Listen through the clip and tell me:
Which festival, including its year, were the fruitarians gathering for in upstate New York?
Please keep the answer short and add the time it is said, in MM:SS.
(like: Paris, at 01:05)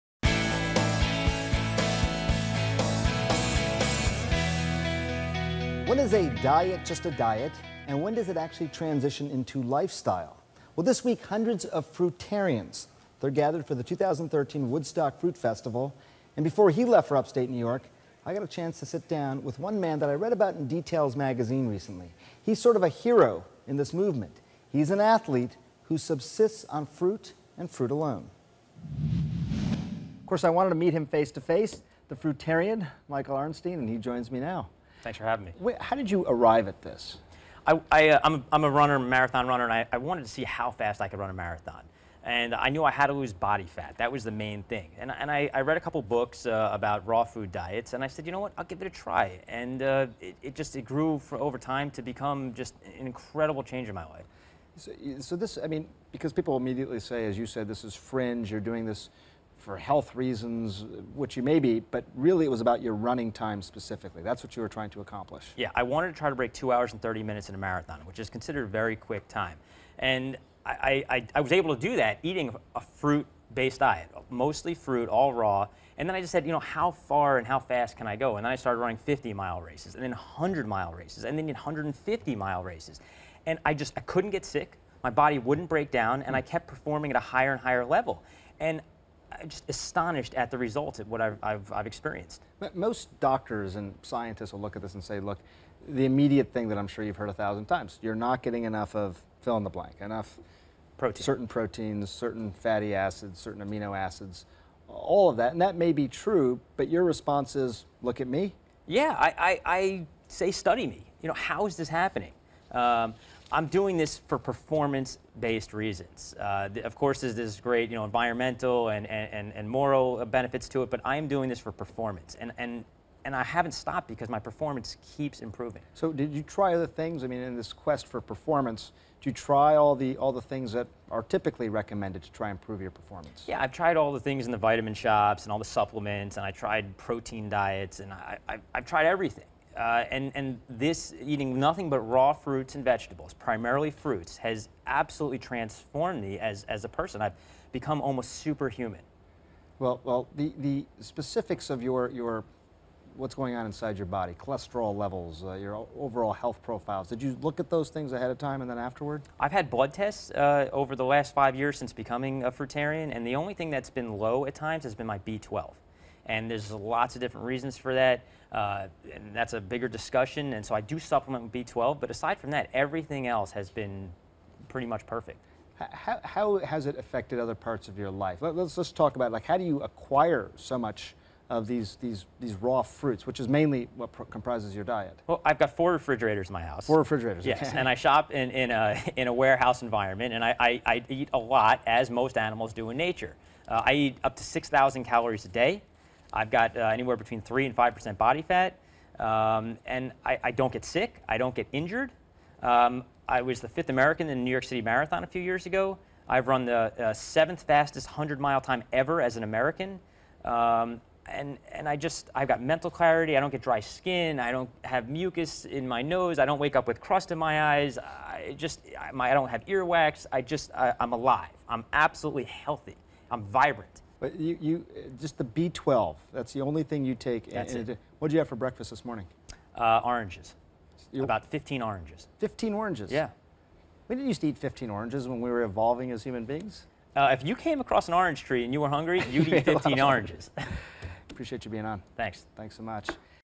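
2013 Woodstock Fruit Festival, at 00:13.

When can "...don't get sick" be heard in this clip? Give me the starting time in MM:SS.
03:20.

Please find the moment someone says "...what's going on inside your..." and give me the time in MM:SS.
02:33.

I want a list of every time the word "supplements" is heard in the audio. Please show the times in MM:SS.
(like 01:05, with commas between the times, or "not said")
02:15, 02:50.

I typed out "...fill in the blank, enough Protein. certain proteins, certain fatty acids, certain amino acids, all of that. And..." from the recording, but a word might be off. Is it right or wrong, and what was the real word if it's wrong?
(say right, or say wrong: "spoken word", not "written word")
right.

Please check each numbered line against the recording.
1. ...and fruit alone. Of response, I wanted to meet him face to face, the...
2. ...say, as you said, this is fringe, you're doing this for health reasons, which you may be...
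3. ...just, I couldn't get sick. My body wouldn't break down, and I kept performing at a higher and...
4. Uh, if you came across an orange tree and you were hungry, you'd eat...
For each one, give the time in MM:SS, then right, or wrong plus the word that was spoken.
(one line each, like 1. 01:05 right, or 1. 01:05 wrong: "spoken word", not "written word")
1. 00:27 wrong: "course", not "response"
2. 00:56 right
3. 01:23 right
4. 03:57 right.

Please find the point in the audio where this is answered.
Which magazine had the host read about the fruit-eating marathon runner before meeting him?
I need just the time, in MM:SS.
00:20.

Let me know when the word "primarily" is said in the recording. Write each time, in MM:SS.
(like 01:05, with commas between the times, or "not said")
02:23.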